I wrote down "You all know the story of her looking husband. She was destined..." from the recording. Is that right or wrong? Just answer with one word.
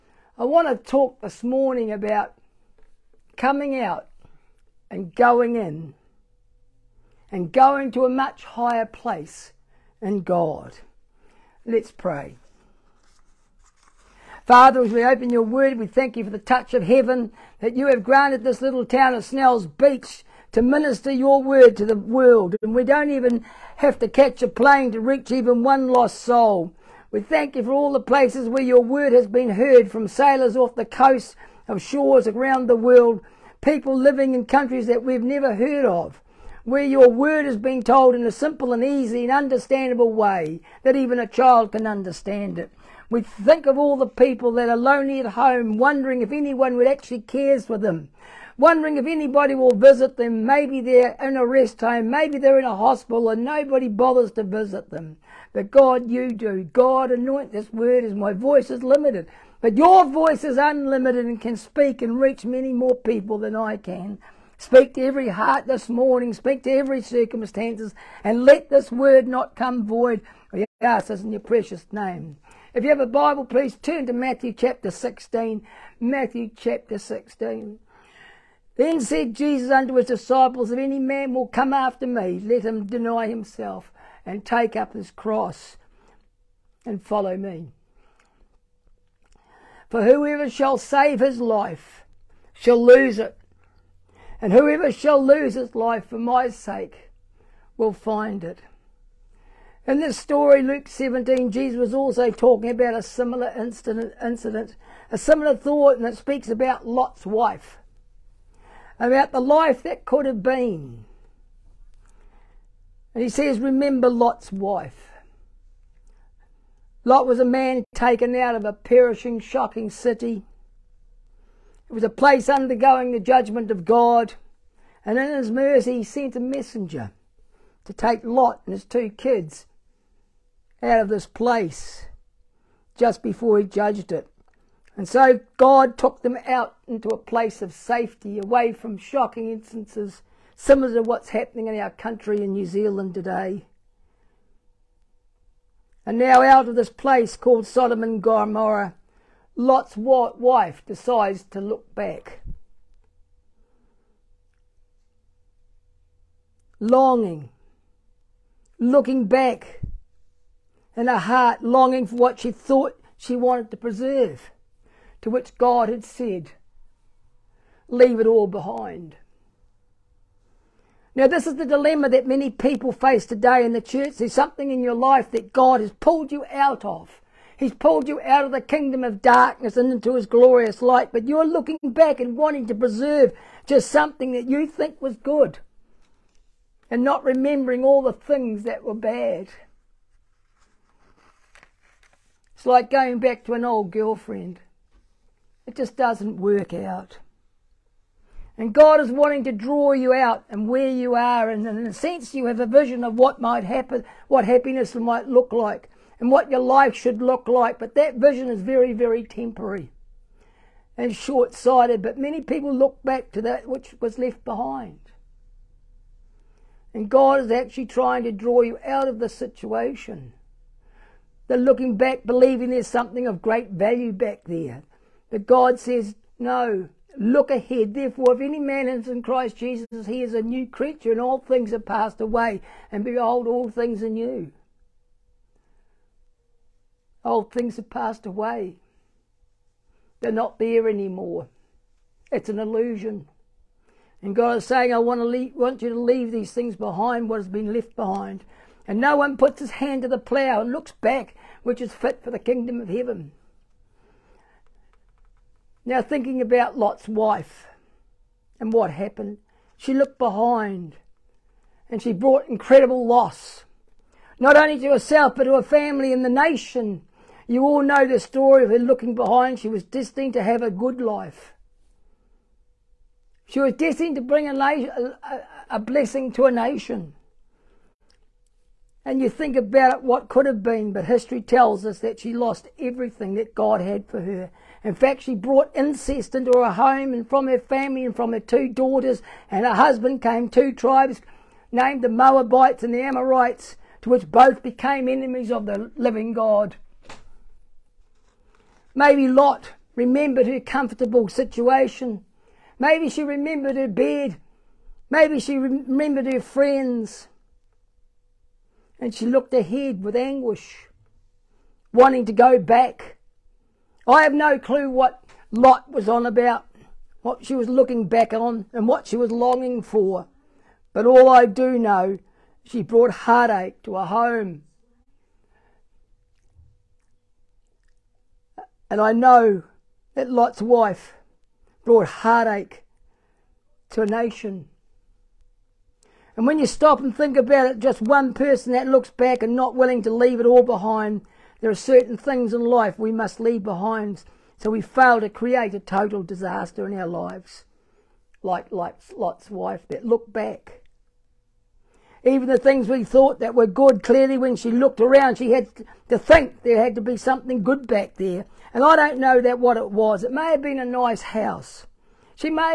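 wrong.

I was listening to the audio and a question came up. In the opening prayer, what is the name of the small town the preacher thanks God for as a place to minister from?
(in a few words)
Snell's Beach.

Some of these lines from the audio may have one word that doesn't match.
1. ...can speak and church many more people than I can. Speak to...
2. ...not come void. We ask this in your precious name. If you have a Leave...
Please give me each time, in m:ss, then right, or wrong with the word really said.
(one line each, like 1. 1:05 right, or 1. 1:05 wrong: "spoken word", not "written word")
1. 1:01 wrong: "reach", not "church"
2. 1:09 wrong: "Bible", not "Leave".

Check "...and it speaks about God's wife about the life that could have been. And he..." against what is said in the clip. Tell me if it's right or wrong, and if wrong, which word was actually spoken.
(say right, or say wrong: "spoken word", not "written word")
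wrong: "Lot", not "God".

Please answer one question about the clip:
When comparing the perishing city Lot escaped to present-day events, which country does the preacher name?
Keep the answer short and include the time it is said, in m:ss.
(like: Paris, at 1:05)
New Zealand, at 2:22.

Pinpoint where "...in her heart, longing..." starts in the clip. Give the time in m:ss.
2:40.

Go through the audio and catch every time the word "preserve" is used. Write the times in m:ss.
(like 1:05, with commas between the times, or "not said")
2:43, 3:02.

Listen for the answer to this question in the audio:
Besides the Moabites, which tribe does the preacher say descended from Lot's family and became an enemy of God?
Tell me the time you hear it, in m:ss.
4:53.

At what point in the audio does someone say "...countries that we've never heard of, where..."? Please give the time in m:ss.
0:34.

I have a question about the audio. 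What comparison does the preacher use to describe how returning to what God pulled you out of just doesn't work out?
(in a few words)
An old girlfriend.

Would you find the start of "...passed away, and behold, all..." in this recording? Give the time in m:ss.
3:51.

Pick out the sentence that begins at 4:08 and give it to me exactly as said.
And no one puts his hand to the plough and looks back, which is fit for the kingdom of heaven.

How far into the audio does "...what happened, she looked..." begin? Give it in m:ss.
4:18.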